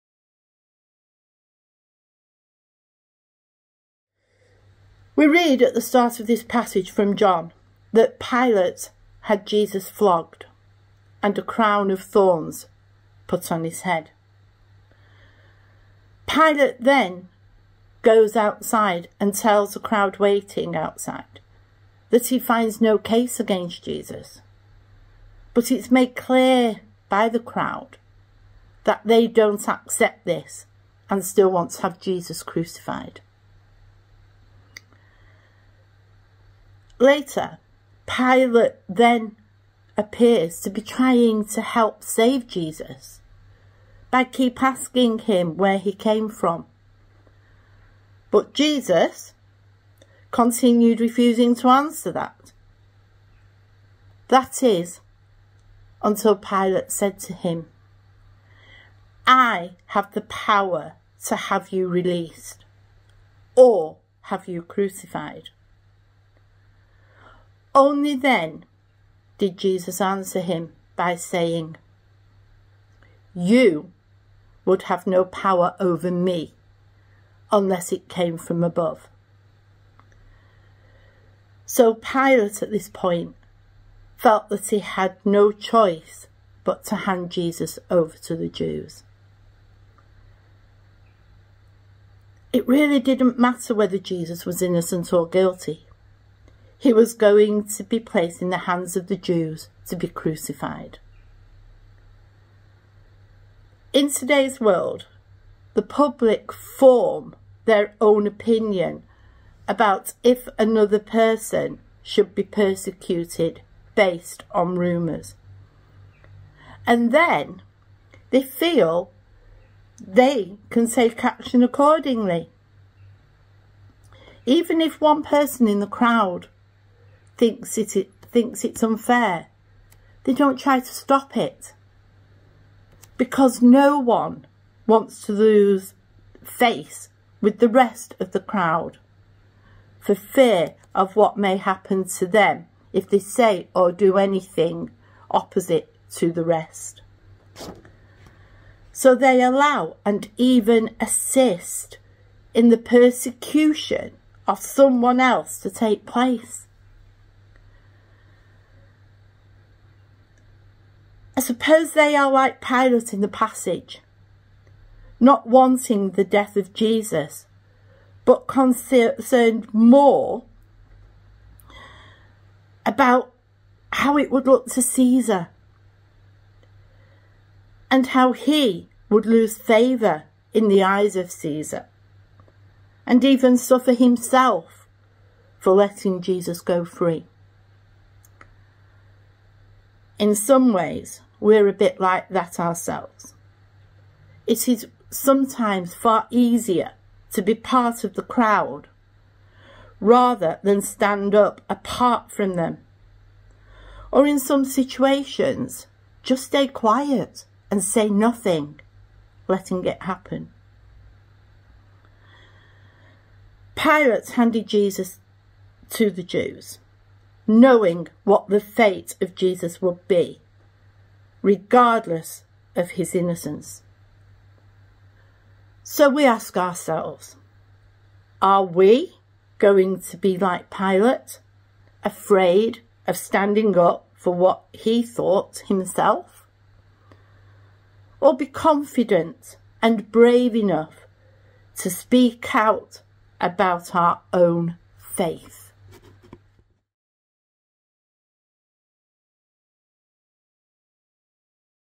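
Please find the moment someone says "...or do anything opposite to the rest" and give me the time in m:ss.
2:23.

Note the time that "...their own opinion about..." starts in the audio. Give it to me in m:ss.
1:47.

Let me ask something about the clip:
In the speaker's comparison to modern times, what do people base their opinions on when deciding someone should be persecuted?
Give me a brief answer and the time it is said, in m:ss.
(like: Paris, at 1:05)
Rumours, at 1:54.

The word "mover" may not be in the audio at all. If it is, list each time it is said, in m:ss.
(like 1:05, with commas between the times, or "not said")
not said.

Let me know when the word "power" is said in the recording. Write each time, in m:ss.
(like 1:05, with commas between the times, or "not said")
1:00, 1:15.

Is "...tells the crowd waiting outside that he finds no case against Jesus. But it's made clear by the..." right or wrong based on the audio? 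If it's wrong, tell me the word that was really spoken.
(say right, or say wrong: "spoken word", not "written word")
right.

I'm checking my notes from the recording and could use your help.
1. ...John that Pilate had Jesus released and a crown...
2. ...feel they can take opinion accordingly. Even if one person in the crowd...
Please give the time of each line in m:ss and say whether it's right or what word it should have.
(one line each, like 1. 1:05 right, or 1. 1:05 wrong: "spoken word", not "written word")
1. 0:07 wrong: "flogged", not "released"
2. 1:58 wrong: "action", not "opinion".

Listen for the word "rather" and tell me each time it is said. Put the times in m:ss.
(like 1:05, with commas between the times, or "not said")
3:19.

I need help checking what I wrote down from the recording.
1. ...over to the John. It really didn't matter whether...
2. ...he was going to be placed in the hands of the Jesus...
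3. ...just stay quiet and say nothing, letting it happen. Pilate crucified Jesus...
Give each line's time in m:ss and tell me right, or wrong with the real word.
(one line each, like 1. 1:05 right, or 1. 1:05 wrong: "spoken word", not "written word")
1. 1:27 wrong: "Jews", not "John"
2. 1:36 wrong: "Jews", not "Jesus"
3. 3:26 wrong: "handed", not "crucified".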